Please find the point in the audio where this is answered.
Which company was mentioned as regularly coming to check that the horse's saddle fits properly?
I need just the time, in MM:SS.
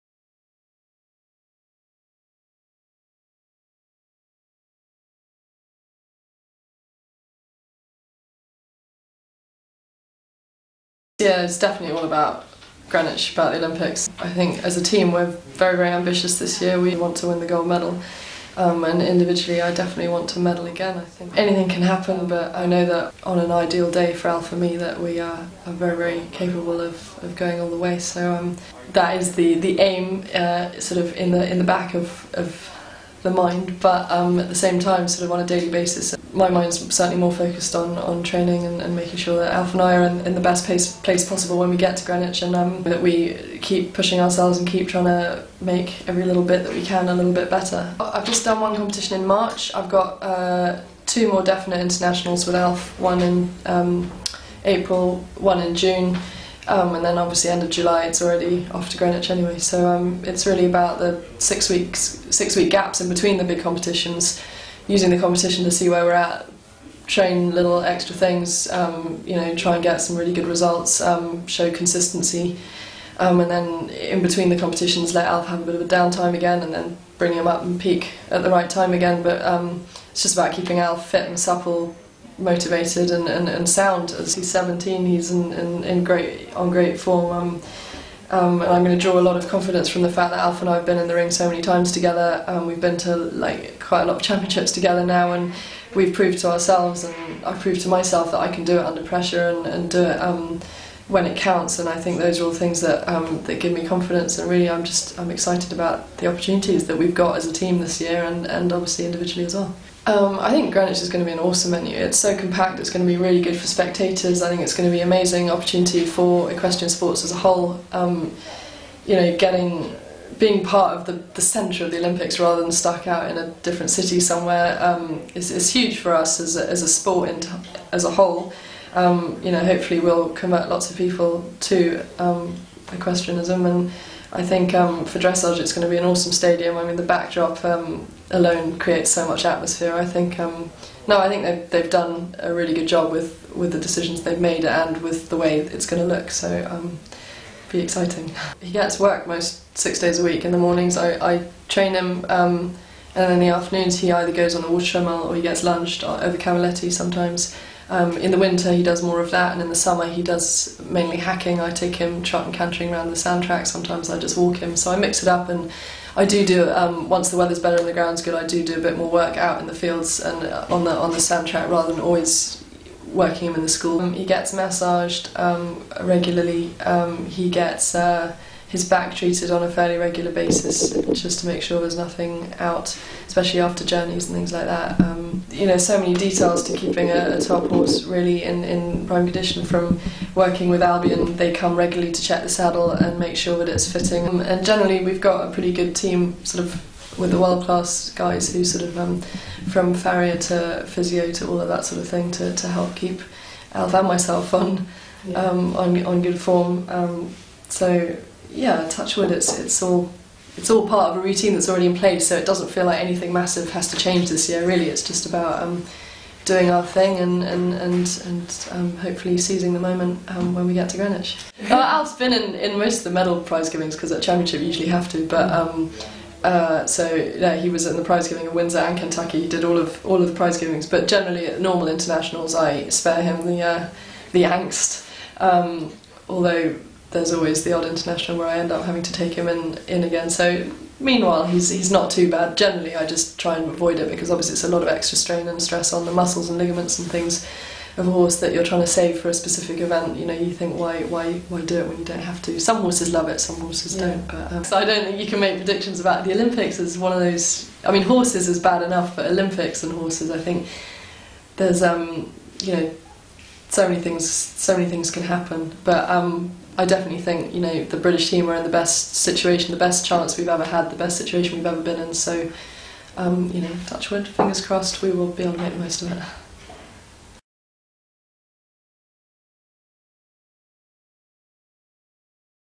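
03:10.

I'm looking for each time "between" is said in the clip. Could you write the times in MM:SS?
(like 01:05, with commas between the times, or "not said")
01:03, 01:14.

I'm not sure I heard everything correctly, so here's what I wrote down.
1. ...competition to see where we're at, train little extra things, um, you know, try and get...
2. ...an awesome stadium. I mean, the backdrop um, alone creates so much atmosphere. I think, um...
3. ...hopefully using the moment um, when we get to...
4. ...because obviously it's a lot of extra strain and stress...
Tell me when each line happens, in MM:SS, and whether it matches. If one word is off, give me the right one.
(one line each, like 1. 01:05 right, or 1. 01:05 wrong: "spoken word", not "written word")
1. 01:05 right
2. 02:15 right
3. 03:38 wrong: "seizing", not "using"
4. 04:04 right.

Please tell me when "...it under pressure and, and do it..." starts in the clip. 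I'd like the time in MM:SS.
01:38.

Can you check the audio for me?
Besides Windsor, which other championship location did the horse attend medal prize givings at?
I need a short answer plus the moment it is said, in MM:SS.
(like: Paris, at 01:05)
Kentucky, at 03:48.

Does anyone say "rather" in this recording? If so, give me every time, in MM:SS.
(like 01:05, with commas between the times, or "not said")
02:02, 02:51.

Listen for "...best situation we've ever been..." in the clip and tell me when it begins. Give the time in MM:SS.
04:30.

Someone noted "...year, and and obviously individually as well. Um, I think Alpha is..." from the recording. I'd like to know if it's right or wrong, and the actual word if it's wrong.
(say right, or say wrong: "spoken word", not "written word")
wrong: "Greenwich", not "Alpha".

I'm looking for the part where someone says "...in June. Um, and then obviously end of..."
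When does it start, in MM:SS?
00:55.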